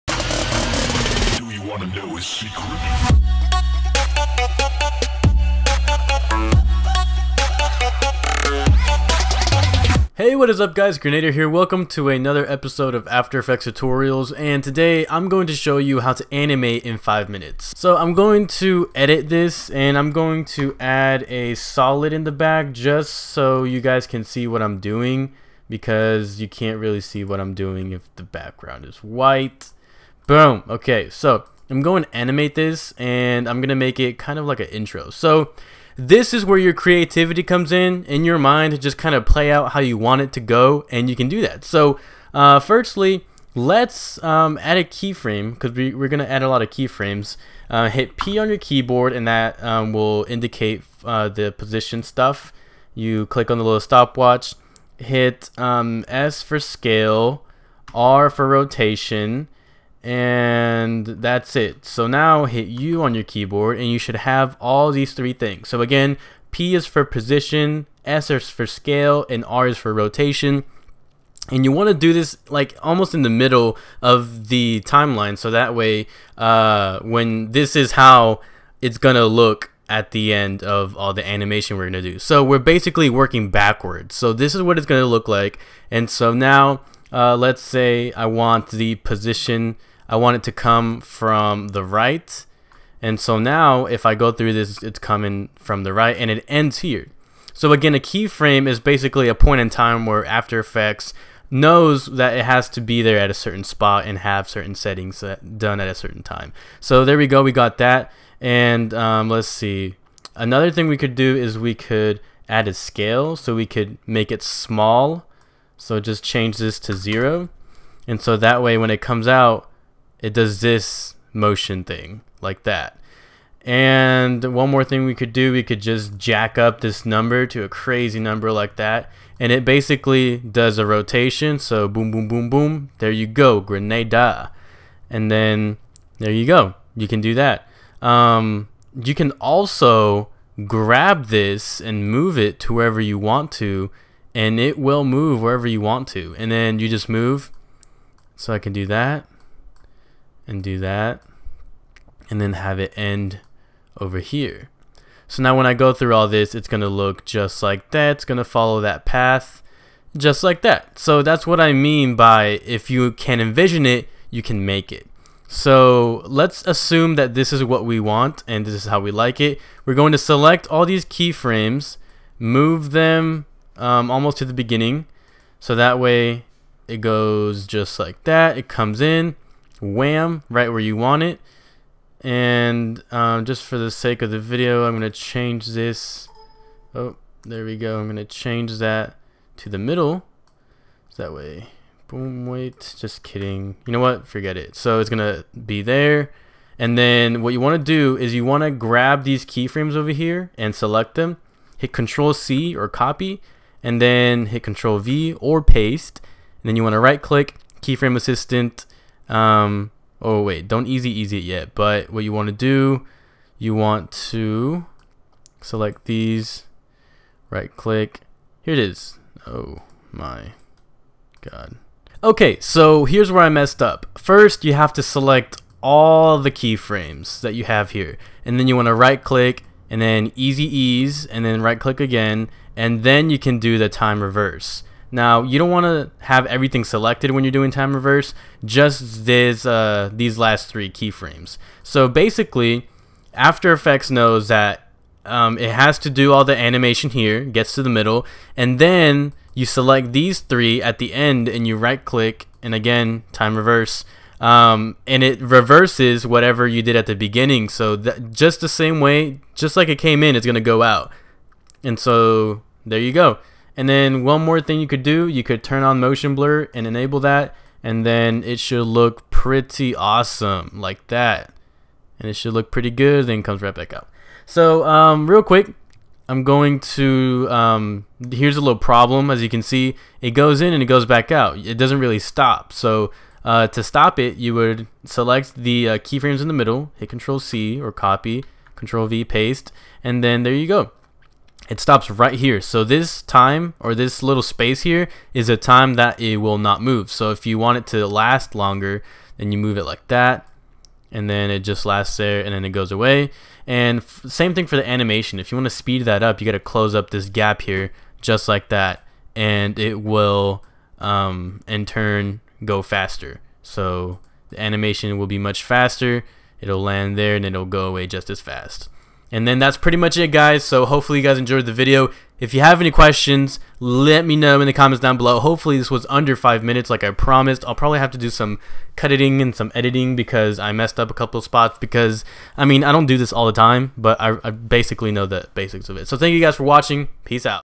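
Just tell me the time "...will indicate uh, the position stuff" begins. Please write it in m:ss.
0:49.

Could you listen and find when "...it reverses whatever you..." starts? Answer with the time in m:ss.
4:15.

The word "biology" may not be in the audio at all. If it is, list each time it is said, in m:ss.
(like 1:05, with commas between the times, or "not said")
not said.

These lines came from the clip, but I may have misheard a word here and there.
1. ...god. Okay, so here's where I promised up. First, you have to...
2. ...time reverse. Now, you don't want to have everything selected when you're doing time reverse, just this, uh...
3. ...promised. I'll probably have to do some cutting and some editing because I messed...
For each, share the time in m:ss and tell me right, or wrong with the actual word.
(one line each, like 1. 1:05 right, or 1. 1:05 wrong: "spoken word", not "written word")
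1. 3:41 wrong: "messed", not "promised"
2. 3:53 right
3. 5:27 right.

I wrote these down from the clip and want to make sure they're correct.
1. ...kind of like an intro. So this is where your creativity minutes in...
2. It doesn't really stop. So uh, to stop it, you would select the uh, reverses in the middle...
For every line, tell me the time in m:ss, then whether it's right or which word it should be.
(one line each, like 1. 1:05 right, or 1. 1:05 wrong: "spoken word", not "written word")
1. 0:34 wrong: "comes", not "minutes"
2. 4:41 wrong: "keyframes", not "reverses".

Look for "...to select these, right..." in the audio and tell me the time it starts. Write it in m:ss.
3:34.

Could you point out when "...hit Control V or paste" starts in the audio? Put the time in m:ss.
3:24.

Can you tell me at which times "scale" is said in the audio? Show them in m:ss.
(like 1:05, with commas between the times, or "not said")
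0:56, 1:08, 1:52.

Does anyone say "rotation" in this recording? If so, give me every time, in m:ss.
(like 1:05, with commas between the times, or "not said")
0:58, 1:09, 2:10.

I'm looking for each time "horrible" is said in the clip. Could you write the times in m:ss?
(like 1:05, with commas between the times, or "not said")
not said.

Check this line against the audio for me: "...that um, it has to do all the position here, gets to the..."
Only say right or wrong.
wrong.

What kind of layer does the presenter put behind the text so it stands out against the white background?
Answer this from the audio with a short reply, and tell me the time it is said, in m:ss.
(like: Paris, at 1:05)
A solid, at 0:21.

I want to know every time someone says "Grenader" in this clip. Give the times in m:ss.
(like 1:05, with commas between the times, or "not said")
0:10, 2:13.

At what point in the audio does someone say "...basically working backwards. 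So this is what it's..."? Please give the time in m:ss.
1:22.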